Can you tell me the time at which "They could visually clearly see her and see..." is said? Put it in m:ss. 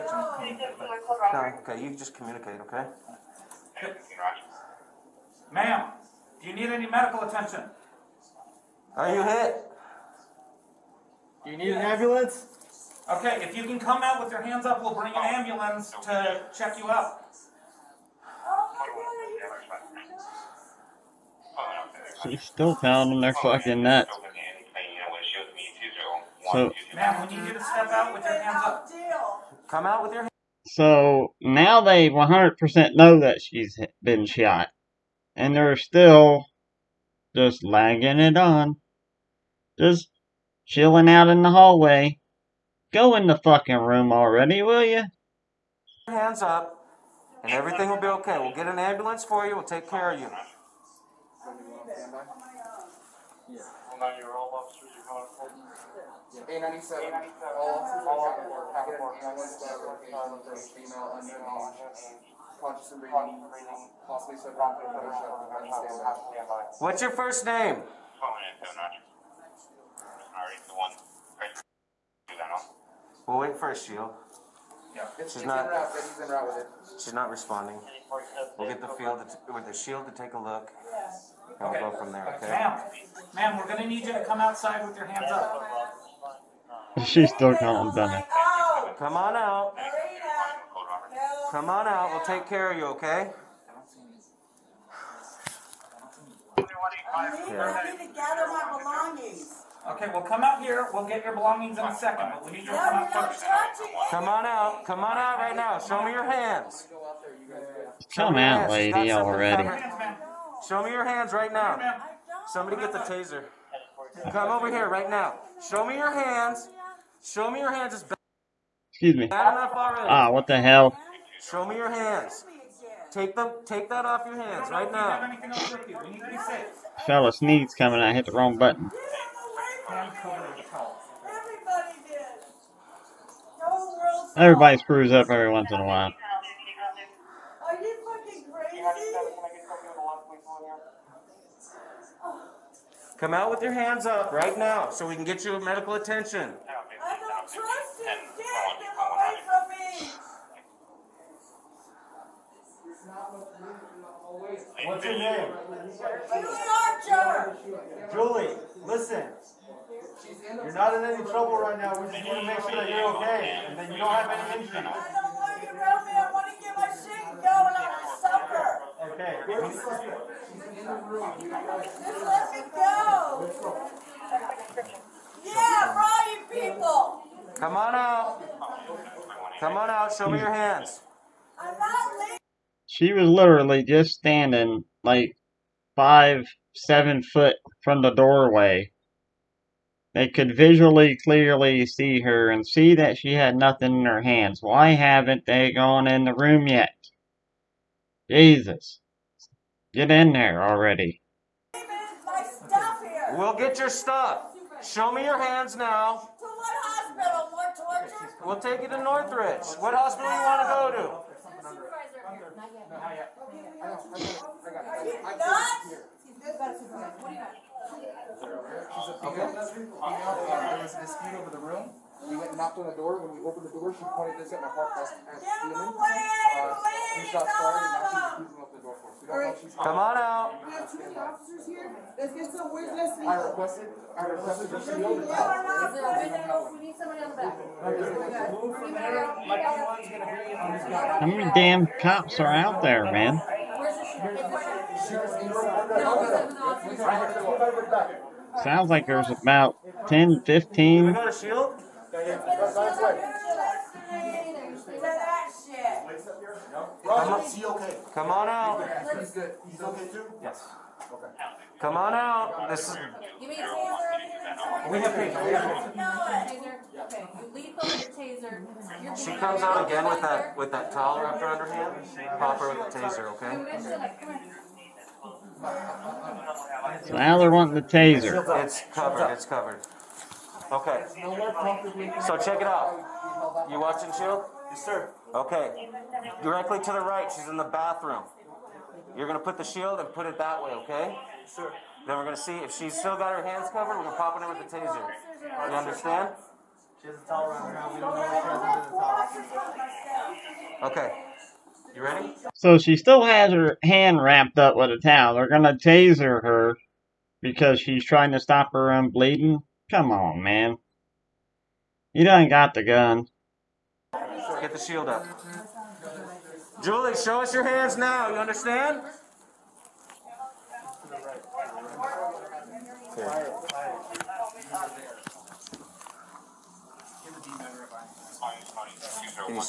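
3:10.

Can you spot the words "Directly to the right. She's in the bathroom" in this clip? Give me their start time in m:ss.
4:46.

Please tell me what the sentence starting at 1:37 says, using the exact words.
I need to gather my belongings.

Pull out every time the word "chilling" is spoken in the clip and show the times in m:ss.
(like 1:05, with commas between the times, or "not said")
0:40.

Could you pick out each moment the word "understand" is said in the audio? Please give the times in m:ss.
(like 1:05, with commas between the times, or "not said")
4:55, 5:18.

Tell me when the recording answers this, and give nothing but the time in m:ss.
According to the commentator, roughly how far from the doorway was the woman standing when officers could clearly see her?
3:05.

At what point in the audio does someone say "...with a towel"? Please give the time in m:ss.
5:04.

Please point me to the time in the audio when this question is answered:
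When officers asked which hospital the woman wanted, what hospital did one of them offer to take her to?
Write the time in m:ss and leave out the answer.
3:29.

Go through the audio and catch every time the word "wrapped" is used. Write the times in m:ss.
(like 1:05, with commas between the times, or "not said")
4:31, 5:04.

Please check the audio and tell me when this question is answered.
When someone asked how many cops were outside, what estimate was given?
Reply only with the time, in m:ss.
4:10.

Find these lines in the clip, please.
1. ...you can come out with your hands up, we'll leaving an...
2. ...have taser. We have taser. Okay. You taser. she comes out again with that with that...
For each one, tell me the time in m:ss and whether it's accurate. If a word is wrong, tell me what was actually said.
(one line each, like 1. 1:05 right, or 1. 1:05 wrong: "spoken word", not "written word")
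1. 0:13 wrong: "bring", not "leaving"
2. 4:24 right.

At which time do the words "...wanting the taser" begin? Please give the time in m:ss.
4:37.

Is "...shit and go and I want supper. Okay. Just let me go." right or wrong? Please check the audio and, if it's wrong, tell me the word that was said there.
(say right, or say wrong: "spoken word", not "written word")
right.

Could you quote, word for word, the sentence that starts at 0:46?
Hands up, and everything will be okay.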